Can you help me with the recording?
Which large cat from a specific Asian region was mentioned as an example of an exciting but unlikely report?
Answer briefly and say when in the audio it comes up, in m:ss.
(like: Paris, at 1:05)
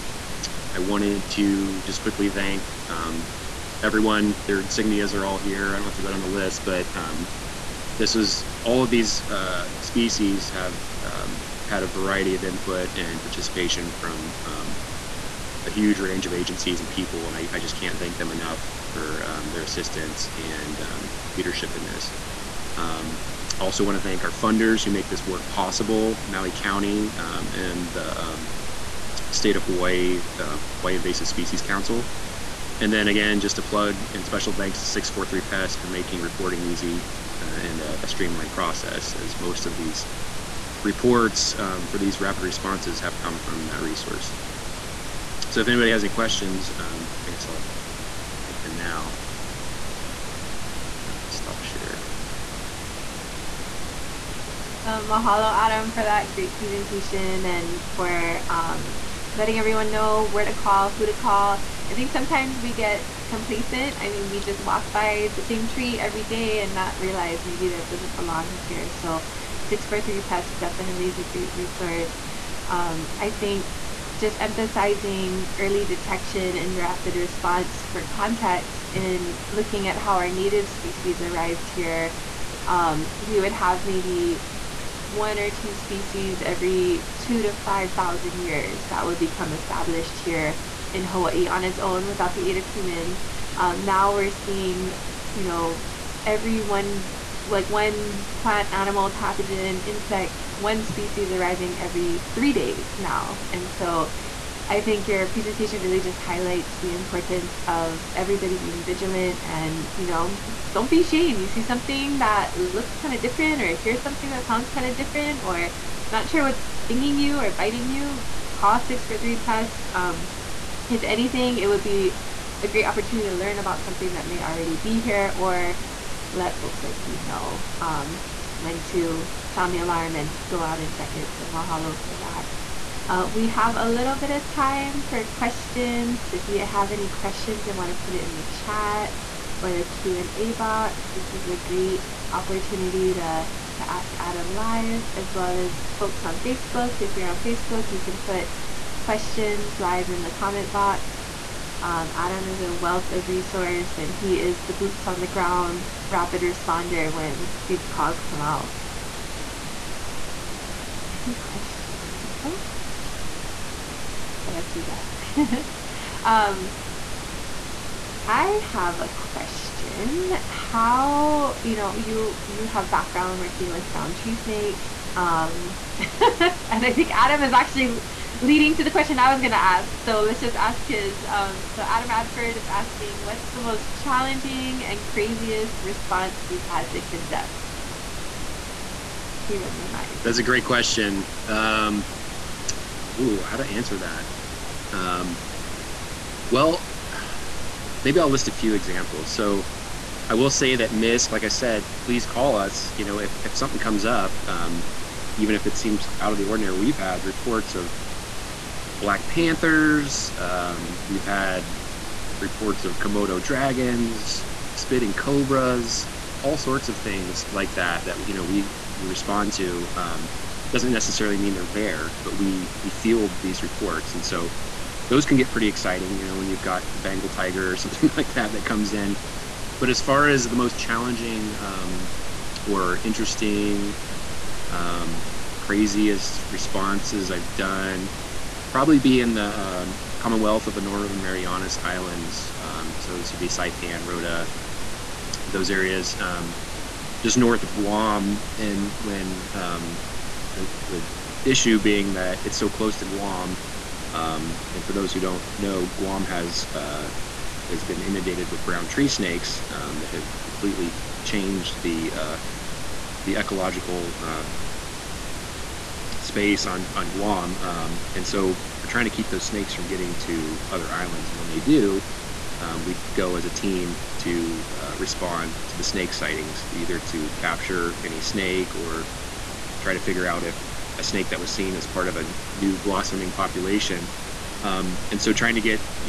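Bengal tiger, at 3:46.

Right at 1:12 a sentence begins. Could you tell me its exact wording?
Um, I think just emphasizing early detection and rapid response for context in looking at how our native species arrived here.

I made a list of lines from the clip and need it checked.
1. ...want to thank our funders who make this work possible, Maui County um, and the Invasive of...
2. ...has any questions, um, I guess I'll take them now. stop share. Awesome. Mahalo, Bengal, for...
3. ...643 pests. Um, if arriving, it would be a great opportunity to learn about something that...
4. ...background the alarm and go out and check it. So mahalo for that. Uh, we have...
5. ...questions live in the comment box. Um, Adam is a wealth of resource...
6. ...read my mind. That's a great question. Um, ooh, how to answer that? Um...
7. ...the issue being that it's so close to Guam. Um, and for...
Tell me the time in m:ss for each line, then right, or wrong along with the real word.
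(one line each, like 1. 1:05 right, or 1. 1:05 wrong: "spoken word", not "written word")
1. 0:23 wrong: "State", not "Invasive"
2. 0:45 wrong: "Adam", not "Bengal"
3. 1:58 wrong: "anything", not "arriving"
4. 2:09 wrong: "sound", not "background"
5. 2:29 right
6. 3:09 right
7. 4:10 right.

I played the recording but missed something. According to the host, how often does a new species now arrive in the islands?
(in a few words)
every 3 days.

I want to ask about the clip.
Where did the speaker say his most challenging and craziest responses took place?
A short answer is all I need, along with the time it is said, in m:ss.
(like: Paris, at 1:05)
Commonwealth of the Northern Marianas Islands, at 4:00.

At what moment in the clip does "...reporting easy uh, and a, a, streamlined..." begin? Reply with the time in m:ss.
0:36.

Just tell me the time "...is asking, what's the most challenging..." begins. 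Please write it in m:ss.
3:02.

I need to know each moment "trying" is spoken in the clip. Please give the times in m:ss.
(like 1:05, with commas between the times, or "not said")
4:28, 4:45.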